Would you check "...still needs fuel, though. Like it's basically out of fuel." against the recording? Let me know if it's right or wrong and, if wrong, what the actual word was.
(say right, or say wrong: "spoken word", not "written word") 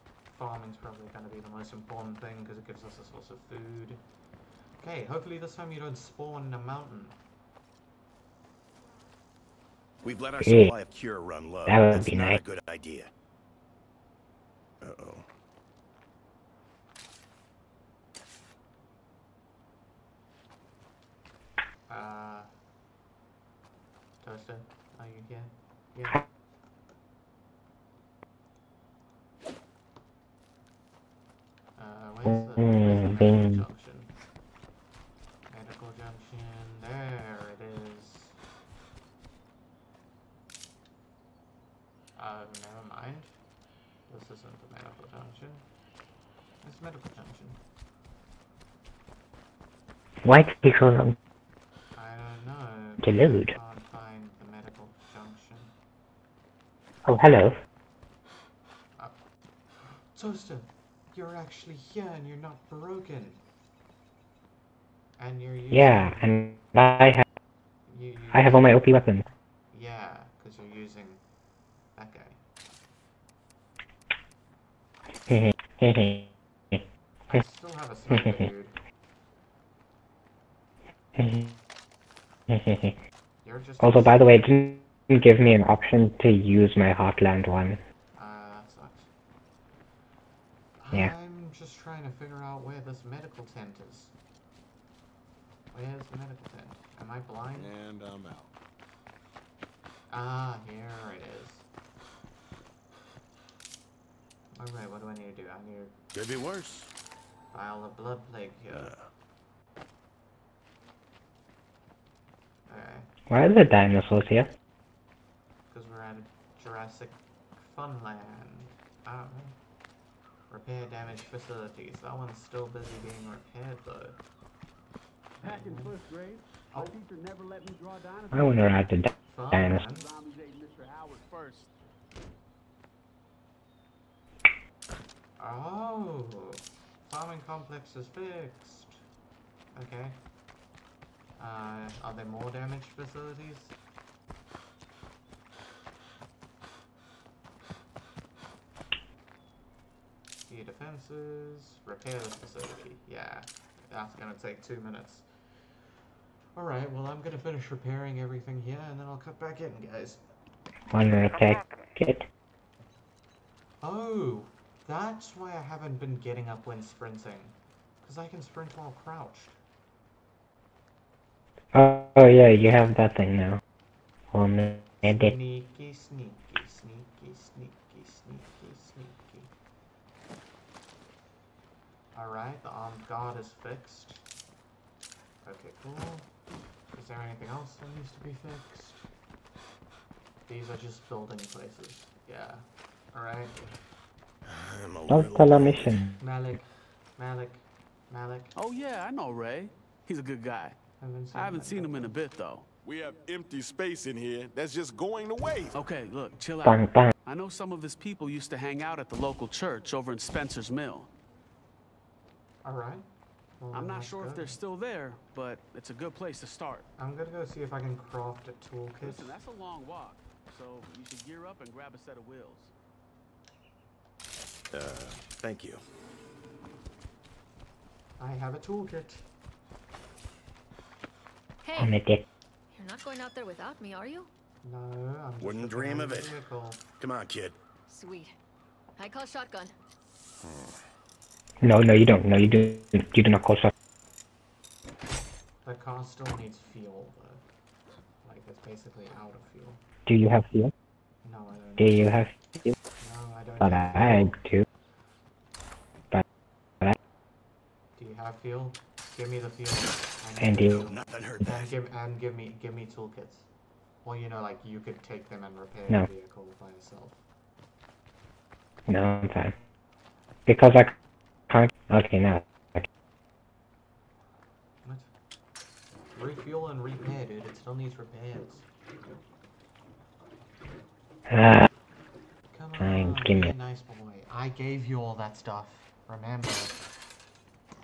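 right.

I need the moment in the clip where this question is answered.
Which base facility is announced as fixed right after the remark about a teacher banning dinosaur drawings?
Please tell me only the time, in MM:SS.
02:17.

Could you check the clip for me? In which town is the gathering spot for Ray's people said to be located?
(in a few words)
Spencer's Mill.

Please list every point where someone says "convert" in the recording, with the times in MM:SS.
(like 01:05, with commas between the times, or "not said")
not said.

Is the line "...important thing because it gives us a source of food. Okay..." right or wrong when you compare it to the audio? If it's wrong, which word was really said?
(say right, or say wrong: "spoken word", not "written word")
right.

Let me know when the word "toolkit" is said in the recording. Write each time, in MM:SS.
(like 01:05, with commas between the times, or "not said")
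03:38, 03:48, 04:22.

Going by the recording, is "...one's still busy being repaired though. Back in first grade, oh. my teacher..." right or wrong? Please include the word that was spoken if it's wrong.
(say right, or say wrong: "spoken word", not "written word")
right.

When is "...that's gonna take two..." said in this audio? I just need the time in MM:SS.
02:33.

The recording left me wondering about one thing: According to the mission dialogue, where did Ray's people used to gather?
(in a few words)
the local church.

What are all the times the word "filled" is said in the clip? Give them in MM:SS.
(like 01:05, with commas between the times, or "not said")
not said.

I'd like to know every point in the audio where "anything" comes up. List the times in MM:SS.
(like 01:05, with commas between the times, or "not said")
03:07.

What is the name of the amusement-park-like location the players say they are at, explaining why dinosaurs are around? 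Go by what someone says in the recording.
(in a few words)
Jurassic Funland.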